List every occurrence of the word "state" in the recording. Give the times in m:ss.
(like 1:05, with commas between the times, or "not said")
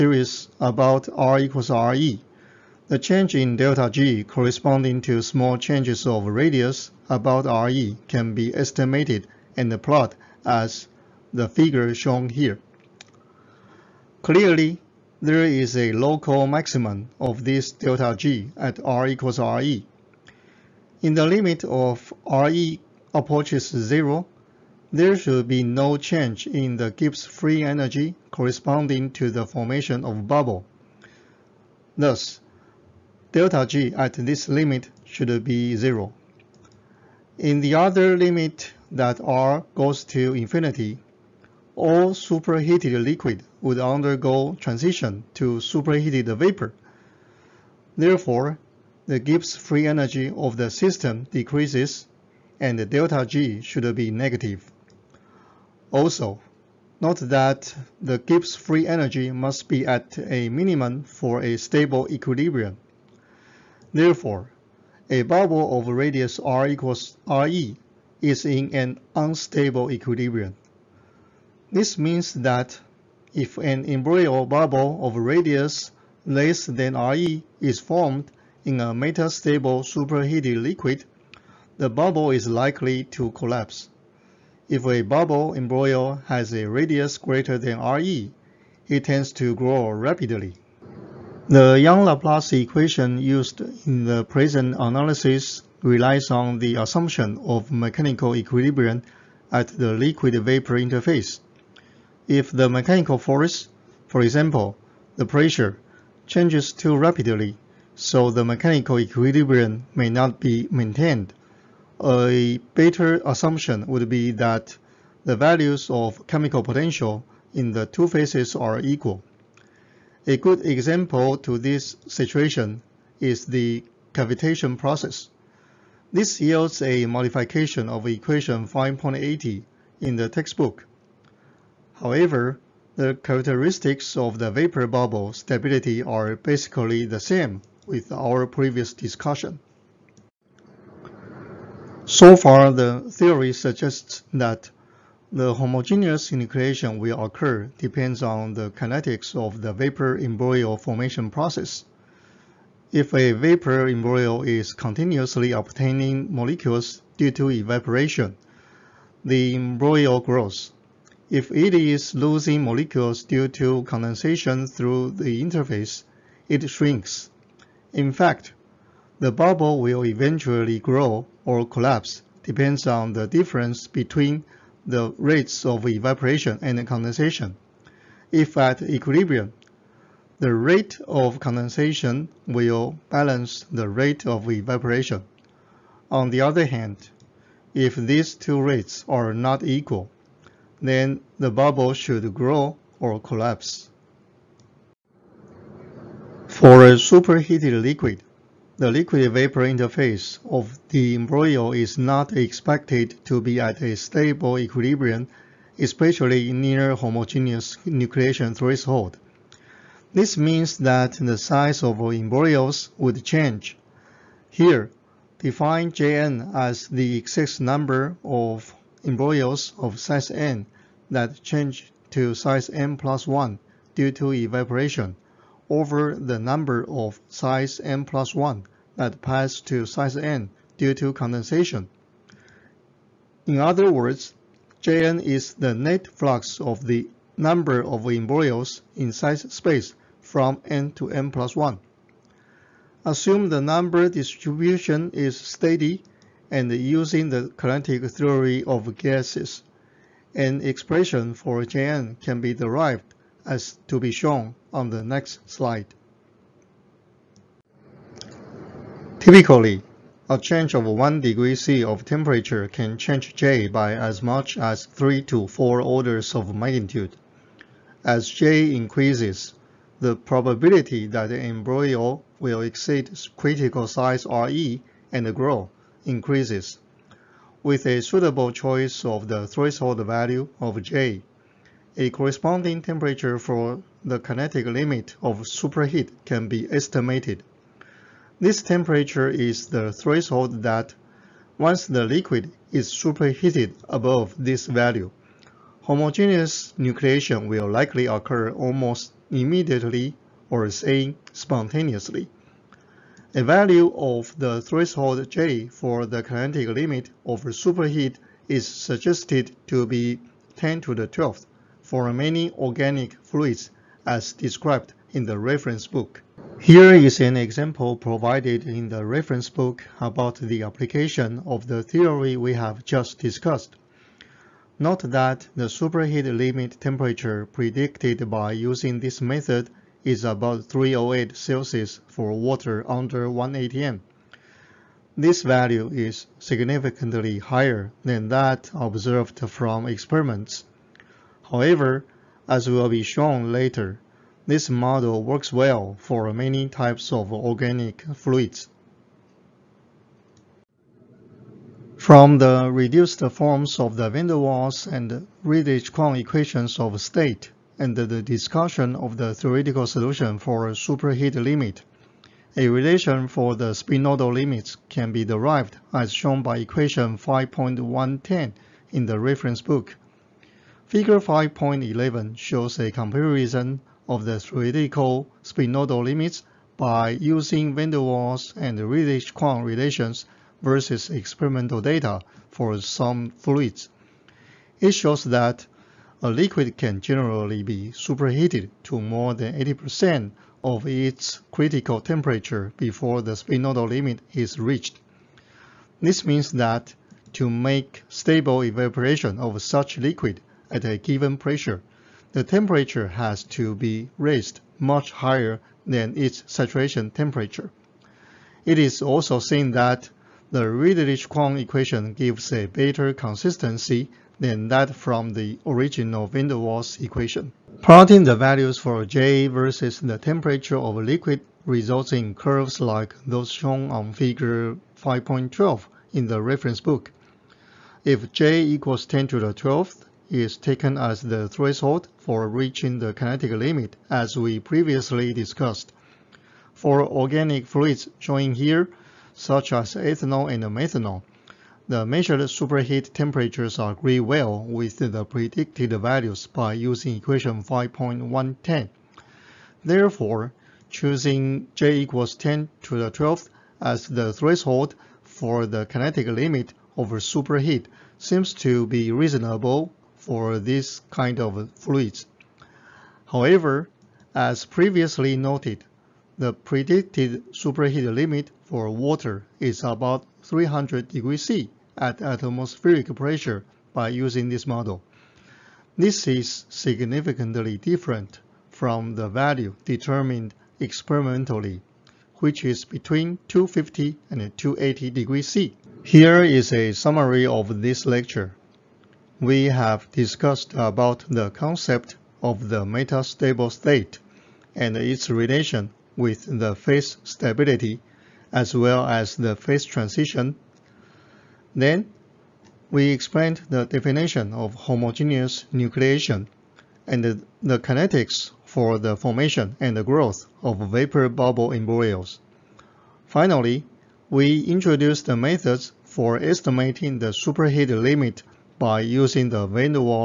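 5:56, 8:13.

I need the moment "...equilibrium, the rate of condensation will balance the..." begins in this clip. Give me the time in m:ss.
2:58.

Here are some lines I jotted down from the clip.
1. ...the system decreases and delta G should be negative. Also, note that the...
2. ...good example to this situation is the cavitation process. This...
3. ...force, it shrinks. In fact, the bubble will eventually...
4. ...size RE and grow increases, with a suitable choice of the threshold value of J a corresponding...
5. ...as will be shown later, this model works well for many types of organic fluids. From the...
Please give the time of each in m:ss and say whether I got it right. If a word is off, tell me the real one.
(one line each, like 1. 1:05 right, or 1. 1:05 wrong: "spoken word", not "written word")
1. 0:50 right
2. 2:00 right
3. 2:45 wrong: "interface", not "force"
4. 4:33 right
5. 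5:42 right.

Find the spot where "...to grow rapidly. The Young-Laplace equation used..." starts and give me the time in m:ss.
1:29.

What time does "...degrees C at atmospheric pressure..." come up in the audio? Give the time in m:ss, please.
7:51.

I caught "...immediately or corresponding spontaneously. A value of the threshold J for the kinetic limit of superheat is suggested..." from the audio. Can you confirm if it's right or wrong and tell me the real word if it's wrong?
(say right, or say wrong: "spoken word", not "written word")
wrong: "saying", not "corresponding".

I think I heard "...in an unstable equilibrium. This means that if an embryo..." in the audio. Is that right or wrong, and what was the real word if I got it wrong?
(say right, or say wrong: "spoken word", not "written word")
right.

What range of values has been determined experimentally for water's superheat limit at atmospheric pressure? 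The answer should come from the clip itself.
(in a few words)
250 to 280 degrees C.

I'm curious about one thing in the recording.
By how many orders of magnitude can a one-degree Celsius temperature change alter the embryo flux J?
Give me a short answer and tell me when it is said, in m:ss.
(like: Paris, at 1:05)
3 to 4, at 4:24.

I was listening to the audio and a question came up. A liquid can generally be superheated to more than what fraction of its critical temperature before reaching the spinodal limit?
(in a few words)
80%.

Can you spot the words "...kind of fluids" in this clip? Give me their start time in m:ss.
7:41.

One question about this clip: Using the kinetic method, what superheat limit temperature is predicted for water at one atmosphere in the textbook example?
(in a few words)
308 degrees Celsius.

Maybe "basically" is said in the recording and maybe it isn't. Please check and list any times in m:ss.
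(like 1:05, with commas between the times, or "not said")
2:16.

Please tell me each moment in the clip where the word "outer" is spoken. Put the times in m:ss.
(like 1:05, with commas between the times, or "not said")
not said.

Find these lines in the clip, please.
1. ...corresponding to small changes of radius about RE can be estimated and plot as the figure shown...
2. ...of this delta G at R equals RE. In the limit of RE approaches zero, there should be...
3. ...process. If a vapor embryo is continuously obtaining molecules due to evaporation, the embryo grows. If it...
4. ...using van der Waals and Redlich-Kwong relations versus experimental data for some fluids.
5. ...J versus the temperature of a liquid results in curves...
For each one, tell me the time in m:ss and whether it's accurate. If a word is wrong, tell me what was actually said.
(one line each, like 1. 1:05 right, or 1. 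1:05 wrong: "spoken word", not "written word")
1. 0:04 right
2. 0:17 right
3. 2:31 right
4. 6:17 right
5. 6:59 right.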